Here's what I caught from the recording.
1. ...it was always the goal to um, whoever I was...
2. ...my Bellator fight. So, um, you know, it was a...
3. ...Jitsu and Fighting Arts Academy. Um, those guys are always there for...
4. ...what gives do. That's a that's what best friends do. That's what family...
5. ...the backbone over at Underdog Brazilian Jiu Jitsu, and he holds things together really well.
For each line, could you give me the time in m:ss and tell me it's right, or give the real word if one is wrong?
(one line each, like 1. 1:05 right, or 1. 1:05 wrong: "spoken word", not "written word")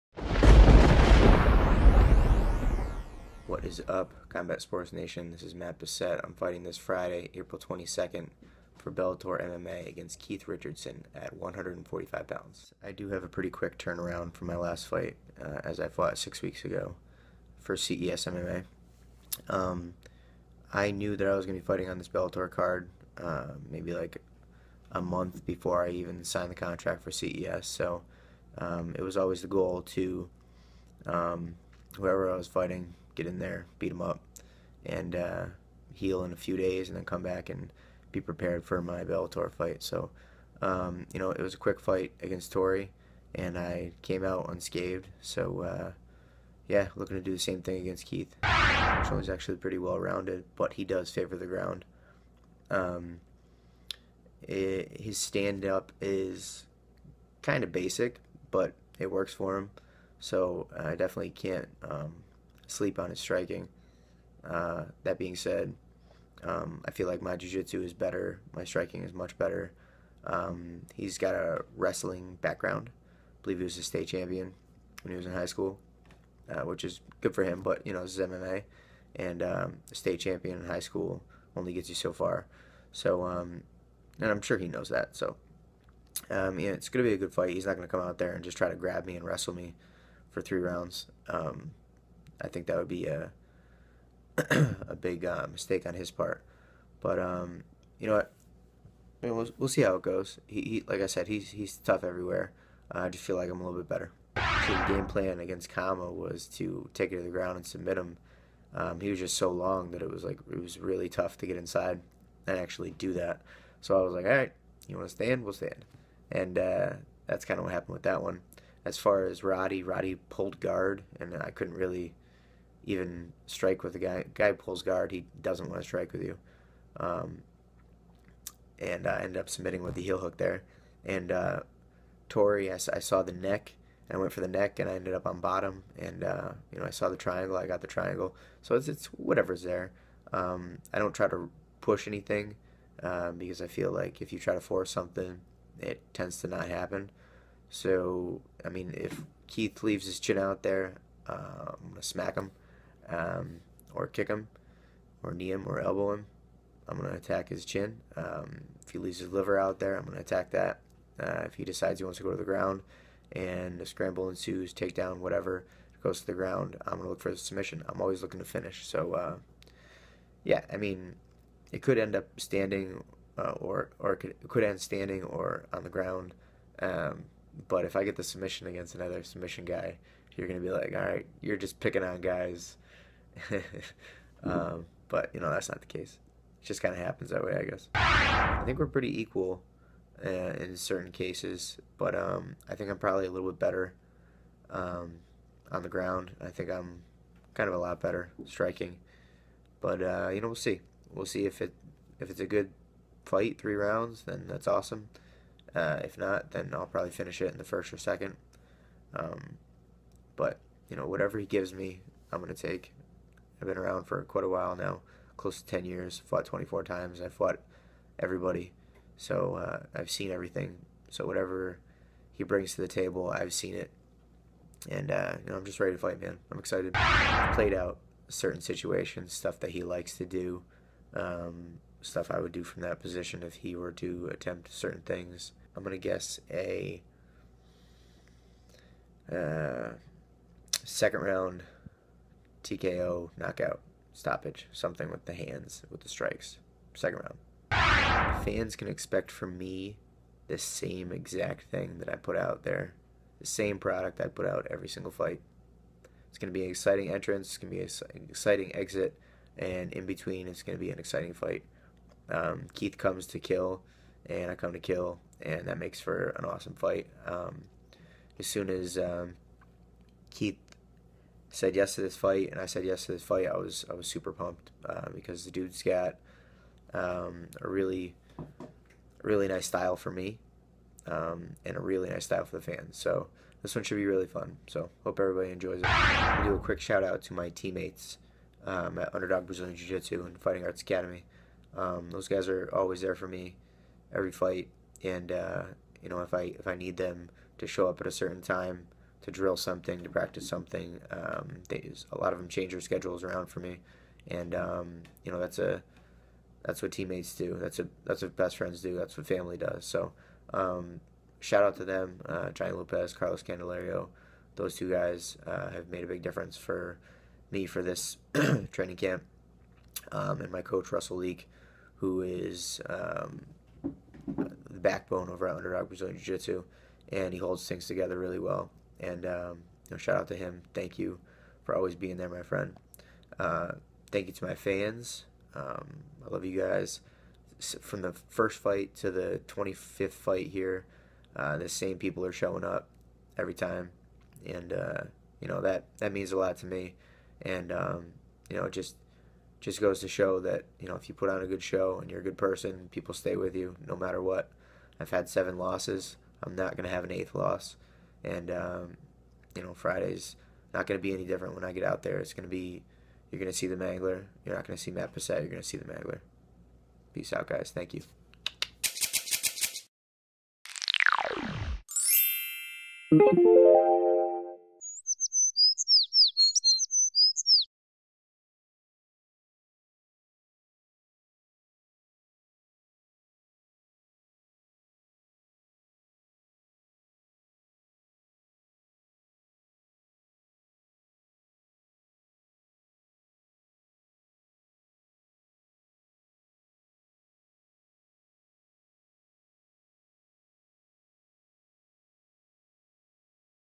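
1. 0:28 right
2. 0:38 right
3. 4:49 right
4. 5:06 wrong: "teammates", not "gives"
5. 5:24 right.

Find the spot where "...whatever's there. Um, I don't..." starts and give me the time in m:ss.
2:19.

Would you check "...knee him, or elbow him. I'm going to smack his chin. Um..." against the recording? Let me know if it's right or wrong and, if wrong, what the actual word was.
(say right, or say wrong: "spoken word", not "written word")
wrong: "attack", not "smack".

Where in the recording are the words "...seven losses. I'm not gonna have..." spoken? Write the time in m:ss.
5:55.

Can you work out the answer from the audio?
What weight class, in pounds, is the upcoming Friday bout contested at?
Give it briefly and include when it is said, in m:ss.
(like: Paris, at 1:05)
145, at 0:11.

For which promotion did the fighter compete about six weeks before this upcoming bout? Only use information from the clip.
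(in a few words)
CES MMA.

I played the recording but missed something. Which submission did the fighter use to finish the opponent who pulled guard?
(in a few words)
heel hook.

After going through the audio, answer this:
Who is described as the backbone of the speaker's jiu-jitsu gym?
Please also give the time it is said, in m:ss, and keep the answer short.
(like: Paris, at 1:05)
Russell Leak, at 5:20.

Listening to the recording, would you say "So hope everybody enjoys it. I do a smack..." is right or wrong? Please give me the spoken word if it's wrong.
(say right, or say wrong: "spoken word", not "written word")
wrong: "quick", not "smack".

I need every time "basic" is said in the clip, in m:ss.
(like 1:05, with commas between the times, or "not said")
0:57.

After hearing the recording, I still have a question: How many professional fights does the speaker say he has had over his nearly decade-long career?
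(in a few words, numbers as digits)
24.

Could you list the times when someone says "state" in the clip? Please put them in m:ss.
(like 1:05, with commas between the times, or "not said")
1:13, 1:19.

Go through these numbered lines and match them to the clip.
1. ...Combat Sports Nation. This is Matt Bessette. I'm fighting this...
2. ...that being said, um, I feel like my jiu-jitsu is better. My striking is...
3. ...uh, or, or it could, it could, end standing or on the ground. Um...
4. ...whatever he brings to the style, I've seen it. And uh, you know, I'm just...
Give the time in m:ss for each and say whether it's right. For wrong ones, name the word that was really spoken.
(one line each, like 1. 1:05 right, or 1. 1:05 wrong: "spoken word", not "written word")
1. 0:04 right
2. 1:05 right
3. 2:53 right
4. 3:41 wrong: "table", not "style".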